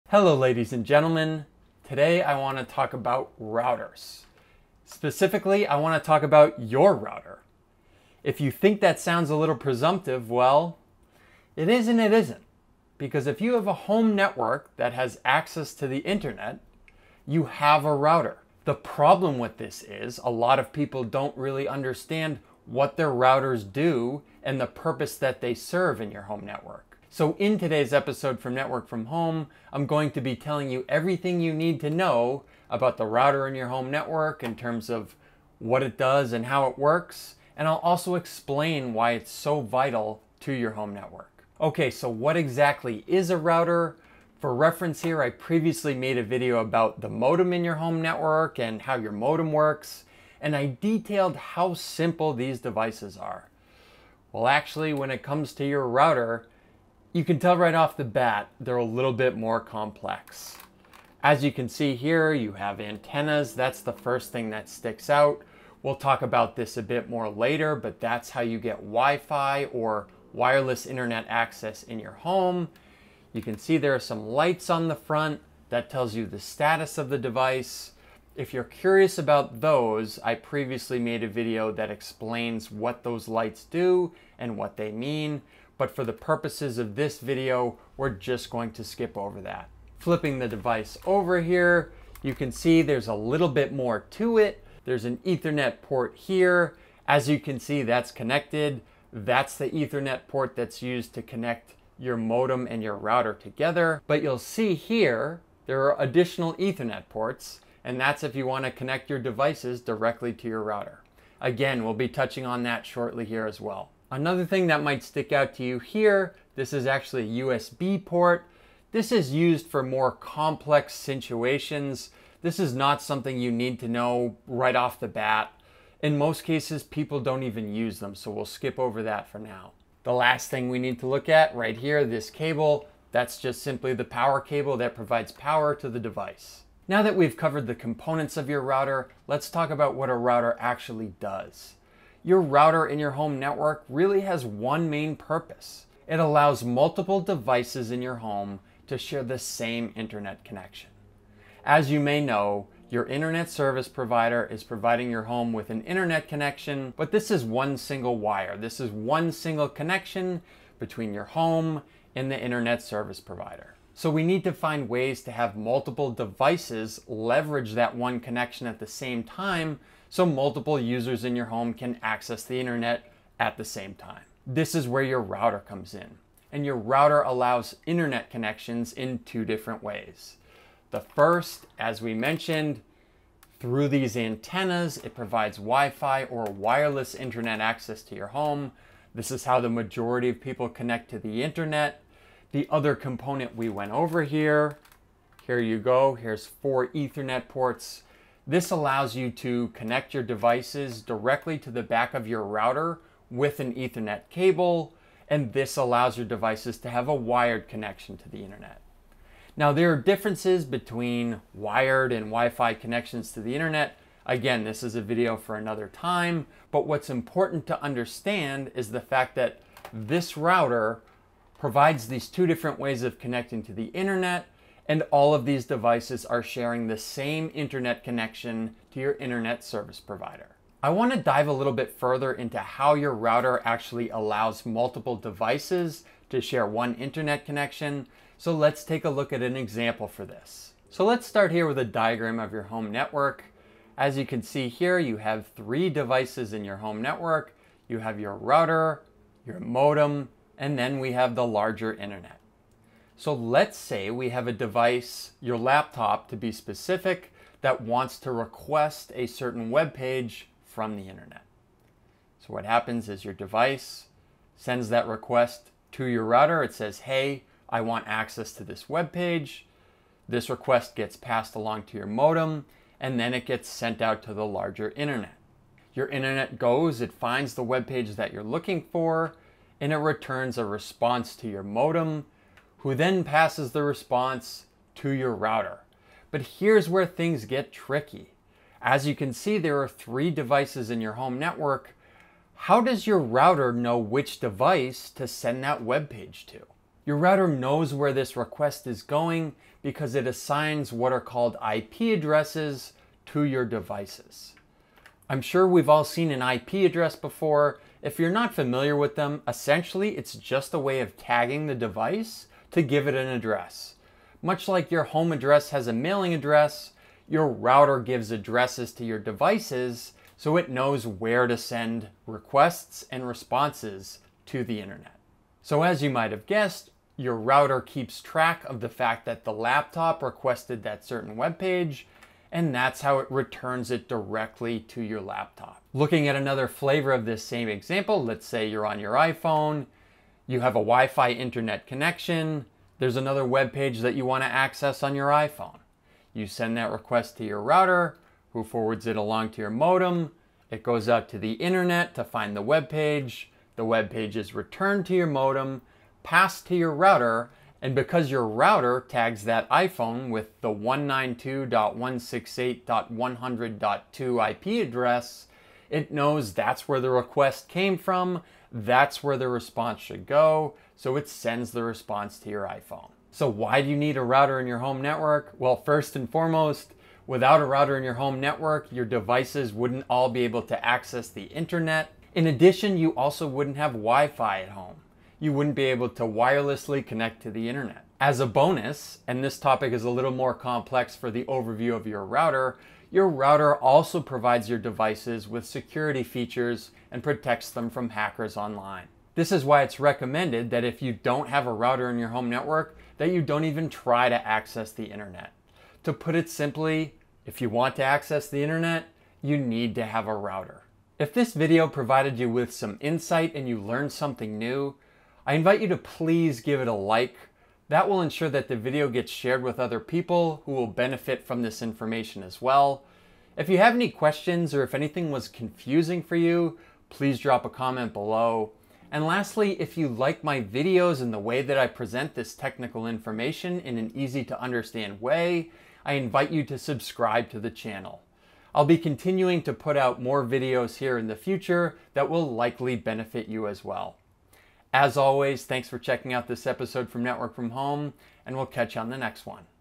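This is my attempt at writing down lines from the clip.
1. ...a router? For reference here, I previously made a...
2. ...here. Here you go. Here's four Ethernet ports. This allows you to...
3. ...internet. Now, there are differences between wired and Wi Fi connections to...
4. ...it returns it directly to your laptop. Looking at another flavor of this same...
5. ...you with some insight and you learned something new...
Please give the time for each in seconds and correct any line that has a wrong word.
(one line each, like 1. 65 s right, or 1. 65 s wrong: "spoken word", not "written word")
1. 43 s right
2. 194 s right
3. 208 s right
4. 333 s right
5. 412 s right.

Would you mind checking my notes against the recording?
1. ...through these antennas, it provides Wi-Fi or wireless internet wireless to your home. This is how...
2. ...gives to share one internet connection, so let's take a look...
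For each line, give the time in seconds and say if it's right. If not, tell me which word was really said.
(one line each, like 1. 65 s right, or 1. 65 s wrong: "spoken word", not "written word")
1. 183 s wrong: "access", not "wireless"
2. 235 s wrong: "devices", not "gives".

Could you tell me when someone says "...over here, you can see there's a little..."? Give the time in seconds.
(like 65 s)
91 s.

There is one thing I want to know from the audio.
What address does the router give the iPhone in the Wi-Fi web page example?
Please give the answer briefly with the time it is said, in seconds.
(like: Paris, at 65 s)
192.168.100.2, at 360 s.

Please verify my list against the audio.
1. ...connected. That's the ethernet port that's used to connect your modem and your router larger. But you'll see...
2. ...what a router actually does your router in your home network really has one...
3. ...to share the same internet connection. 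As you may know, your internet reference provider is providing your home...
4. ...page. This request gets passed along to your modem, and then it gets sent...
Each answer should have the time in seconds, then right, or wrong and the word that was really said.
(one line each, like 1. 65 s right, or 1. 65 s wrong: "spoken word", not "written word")
1. 98 s wrong: "together", not "larger"
2. 139 s right
3. 148 s wrong: "service", not "reference"
4. 269 s right.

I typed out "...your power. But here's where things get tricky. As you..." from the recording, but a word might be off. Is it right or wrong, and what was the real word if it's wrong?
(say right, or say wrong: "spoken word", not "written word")
wrong: "router", not "power".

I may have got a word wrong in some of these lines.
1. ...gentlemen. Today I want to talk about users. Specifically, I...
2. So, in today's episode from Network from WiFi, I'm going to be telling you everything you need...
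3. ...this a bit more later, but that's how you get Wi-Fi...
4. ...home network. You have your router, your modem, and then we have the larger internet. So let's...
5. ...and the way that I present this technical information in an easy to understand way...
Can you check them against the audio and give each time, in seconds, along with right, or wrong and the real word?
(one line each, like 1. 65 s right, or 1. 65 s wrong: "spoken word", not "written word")
1. 0 s wrong: "routers", not "users"
2. 27 s wrong: "Home", not "WiFi"
3. 66 s right
4. 246 s right
5. 431 s right.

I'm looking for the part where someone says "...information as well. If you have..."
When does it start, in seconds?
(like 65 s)
421 s.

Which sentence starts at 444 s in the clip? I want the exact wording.
As always, thanks for checking out this episode from Network from Home, and we'll catch you on the next one.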